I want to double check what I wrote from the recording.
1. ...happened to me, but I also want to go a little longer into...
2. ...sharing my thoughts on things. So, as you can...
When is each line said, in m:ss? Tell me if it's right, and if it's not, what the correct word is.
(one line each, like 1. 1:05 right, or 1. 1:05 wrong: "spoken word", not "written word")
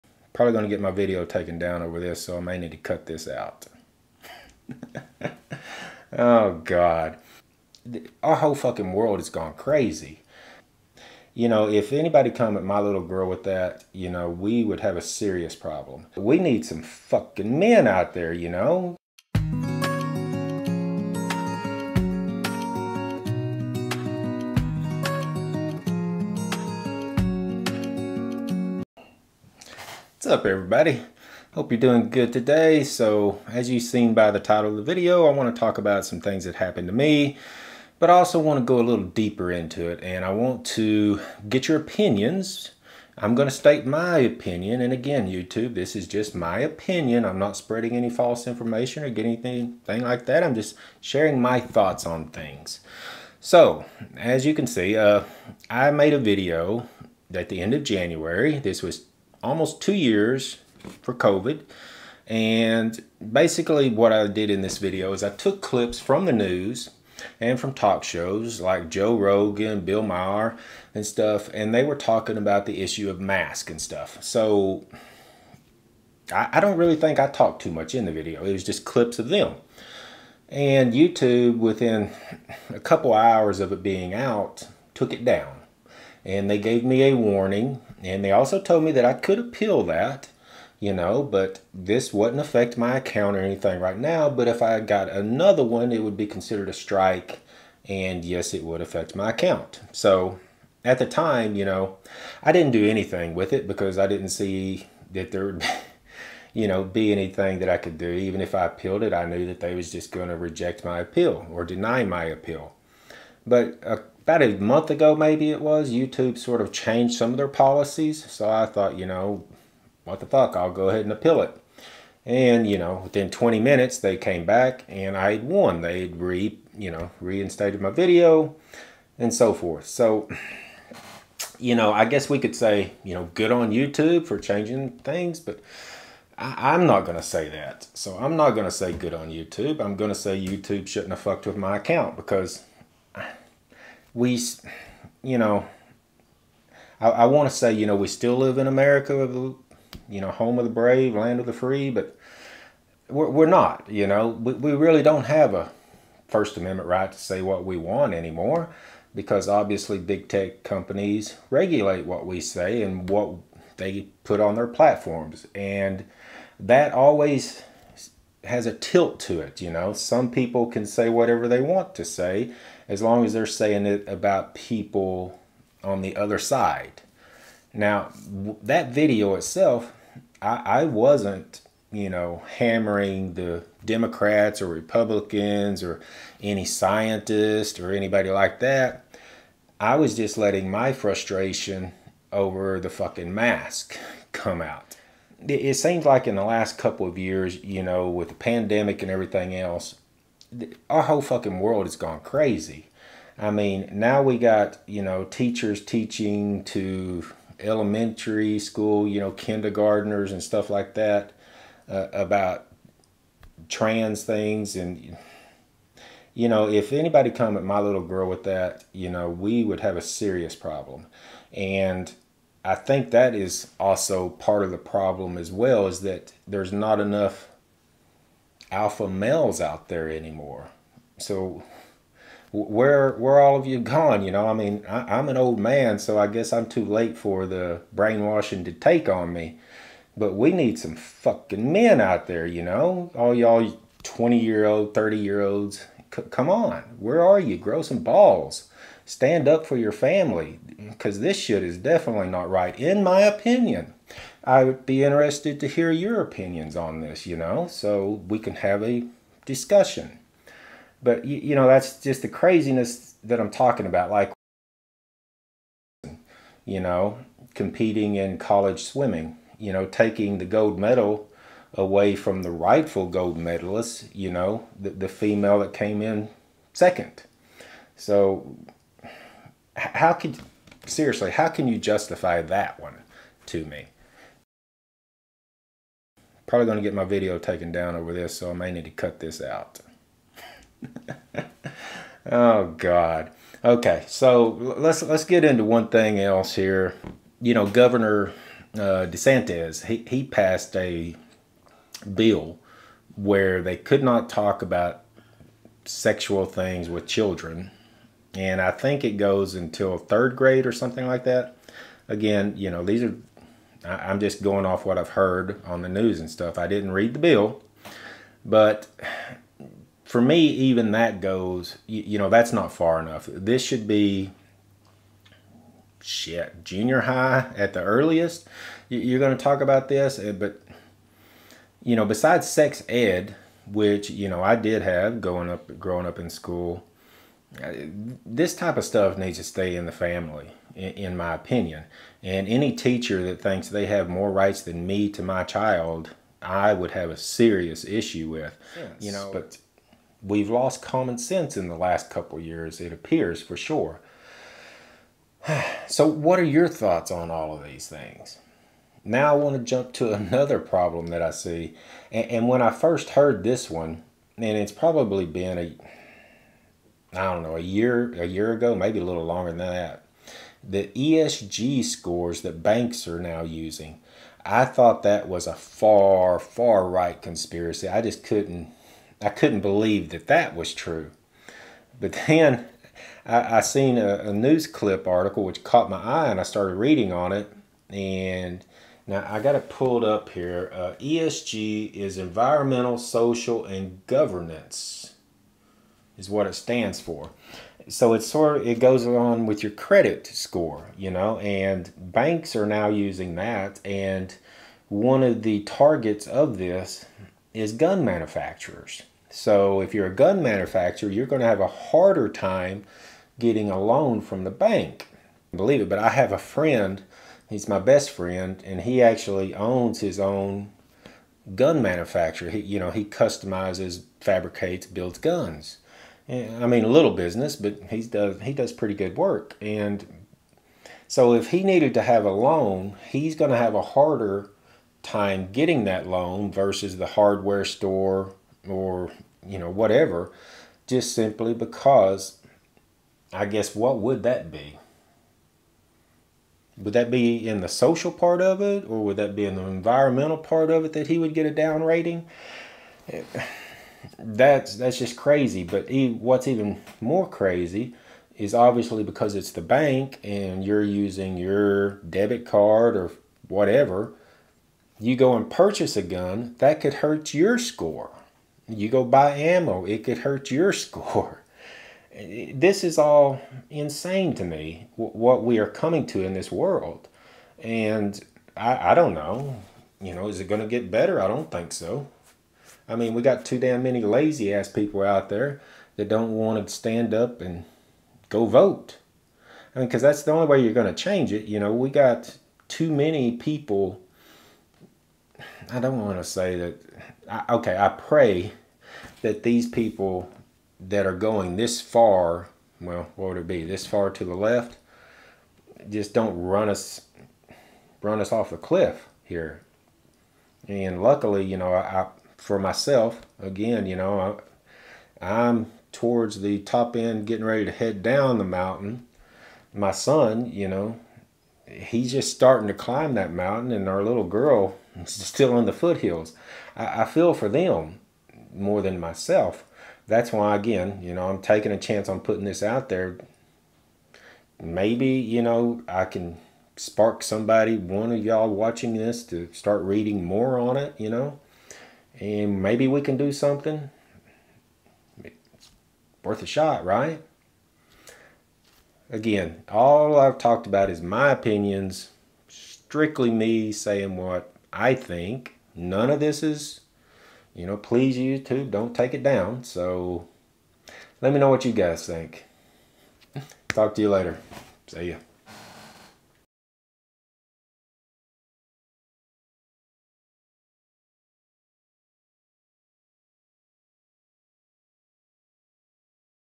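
1. 0:36 wrong: "deeper", not "longer"
2. 0:50 right.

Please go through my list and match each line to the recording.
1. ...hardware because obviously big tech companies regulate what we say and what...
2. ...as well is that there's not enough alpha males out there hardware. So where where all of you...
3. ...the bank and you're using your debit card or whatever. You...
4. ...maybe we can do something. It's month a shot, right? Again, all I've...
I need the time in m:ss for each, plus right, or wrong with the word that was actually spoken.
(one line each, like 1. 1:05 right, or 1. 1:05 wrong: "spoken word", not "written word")
1. 2:38 wrong: "anymore", not "hardware"
2. 3:45 wrong: "anymore", not "hardware"
3. 7:39 right
4. 9:02 wrong: "worth", not "month".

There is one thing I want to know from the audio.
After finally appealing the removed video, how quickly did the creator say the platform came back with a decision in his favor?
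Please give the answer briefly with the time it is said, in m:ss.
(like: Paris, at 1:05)
20 minutes, at 2:03.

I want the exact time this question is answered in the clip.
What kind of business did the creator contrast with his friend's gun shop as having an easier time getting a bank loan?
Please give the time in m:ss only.
7:17.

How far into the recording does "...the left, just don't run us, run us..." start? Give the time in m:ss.
8:24.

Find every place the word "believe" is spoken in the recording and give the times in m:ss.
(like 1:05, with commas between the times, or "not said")
6:19, 6:55.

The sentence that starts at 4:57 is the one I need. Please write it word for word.
You know, Governor uh, DeSantis, he, he passed a bill where they could not talk about sexual things with children.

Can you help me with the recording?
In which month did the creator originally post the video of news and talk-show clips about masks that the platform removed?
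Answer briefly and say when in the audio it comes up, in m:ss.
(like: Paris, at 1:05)
January, at 0:57.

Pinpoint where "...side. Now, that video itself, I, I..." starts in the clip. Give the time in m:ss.
2:56.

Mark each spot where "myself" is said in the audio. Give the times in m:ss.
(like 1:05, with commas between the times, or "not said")
8:32, 8:48.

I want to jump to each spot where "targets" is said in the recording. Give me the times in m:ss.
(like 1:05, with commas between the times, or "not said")
6:45.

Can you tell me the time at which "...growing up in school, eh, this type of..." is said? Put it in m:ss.
5:35.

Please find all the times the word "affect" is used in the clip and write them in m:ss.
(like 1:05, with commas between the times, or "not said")
1:32, 1:38.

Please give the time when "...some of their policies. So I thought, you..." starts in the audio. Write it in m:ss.
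1:57.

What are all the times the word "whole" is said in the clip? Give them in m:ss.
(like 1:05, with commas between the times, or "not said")
0:08, 3:21.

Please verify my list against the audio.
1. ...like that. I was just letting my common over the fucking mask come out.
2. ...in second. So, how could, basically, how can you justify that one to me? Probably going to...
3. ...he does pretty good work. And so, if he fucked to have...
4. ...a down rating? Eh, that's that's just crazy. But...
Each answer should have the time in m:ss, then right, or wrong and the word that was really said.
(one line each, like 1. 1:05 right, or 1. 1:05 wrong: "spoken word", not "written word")
1. 3:08 wrong: "frustration", not "common"
2. 4:36 wrong: "seriously", not "basically"
3. 7:08 wrong: "needed", not "fucked"
4. 7:31 right.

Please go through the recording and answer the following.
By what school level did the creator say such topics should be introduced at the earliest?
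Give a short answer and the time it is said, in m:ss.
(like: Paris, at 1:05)
Junior high, at 5:26.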